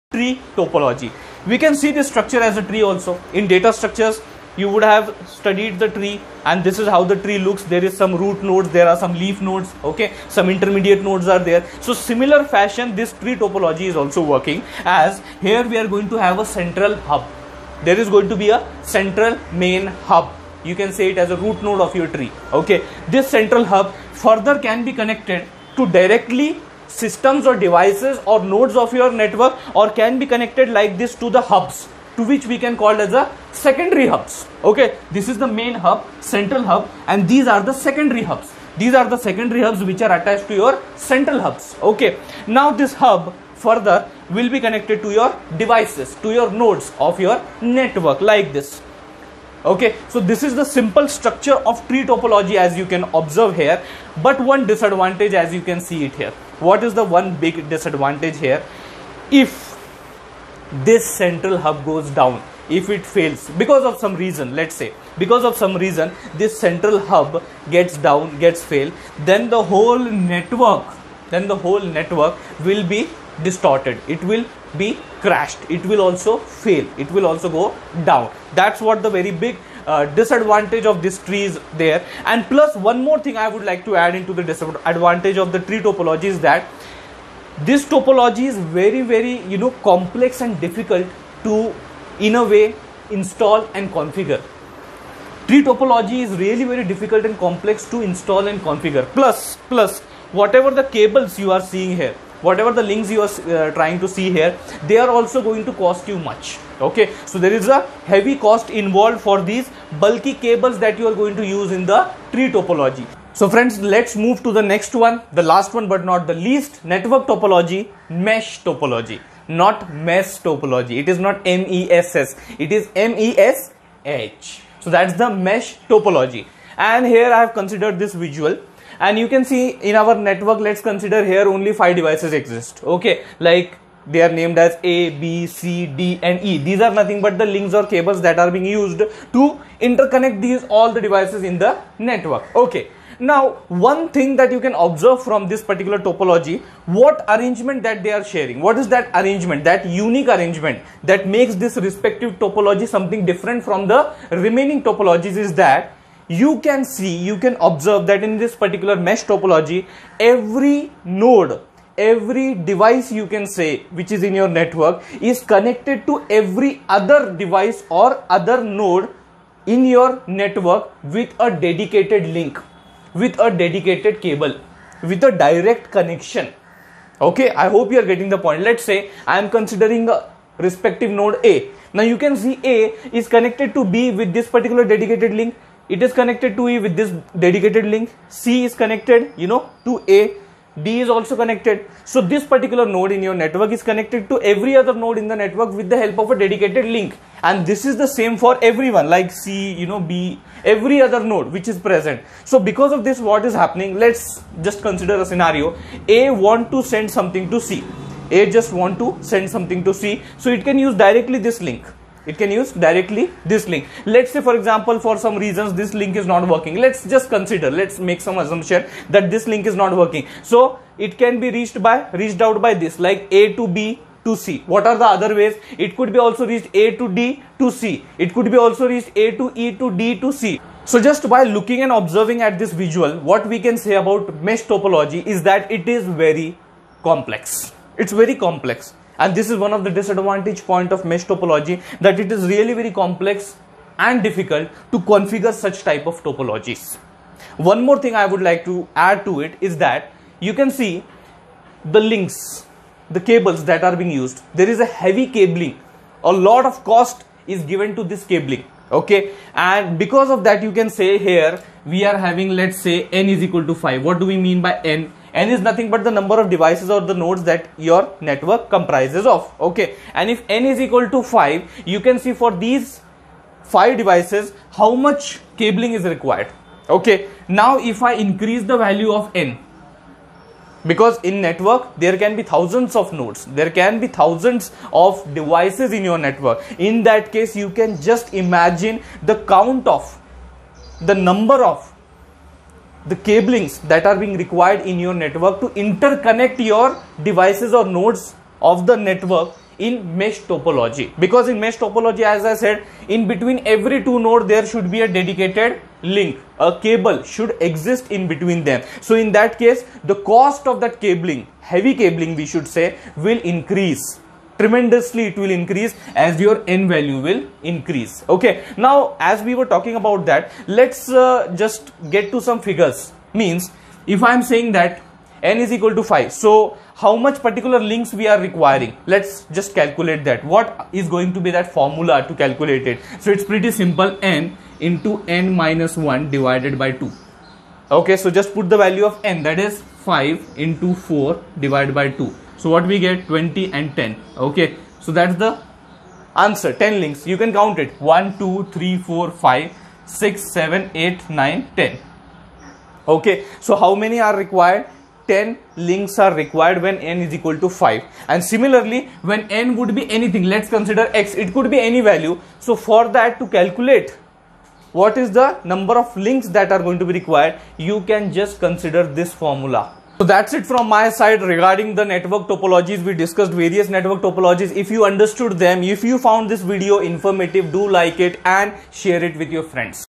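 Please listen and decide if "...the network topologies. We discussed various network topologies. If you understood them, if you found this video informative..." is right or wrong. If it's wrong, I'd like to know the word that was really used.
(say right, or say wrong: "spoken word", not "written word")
right.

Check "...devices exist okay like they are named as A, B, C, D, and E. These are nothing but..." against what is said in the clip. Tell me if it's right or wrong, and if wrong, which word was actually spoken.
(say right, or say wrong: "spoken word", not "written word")
right.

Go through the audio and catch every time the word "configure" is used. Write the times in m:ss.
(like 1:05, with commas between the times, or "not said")
1:33, 1:38, 4:05.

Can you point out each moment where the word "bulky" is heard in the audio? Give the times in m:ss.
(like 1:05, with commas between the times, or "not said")
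1:50.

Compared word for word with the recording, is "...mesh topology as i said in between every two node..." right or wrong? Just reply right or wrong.
right.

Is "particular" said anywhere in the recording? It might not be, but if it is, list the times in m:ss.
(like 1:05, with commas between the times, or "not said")
2:25, 2:38, 3:04, 3:12, 5:27.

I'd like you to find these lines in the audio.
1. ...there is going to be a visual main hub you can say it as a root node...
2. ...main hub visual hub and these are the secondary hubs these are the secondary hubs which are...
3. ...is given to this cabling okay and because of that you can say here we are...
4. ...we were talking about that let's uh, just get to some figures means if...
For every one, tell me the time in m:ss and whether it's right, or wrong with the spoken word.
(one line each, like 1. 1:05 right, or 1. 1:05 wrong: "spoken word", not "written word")
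1. 0:17 wrong: "central", not "visual"
2. 0:35 wrong: "central", not "visual"
3. 4:17 right
4. 5:19 right.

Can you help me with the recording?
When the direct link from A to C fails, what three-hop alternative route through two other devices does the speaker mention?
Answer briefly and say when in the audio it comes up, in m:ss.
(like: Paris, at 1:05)
A to E to D to C, at 3:49.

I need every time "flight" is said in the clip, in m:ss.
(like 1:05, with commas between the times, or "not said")
not said.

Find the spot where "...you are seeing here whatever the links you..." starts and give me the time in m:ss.
1:41.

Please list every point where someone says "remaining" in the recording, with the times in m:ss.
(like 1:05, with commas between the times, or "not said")
2:34.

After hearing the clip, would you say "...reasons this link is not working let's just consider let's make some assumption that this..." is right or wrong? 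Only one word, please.
right.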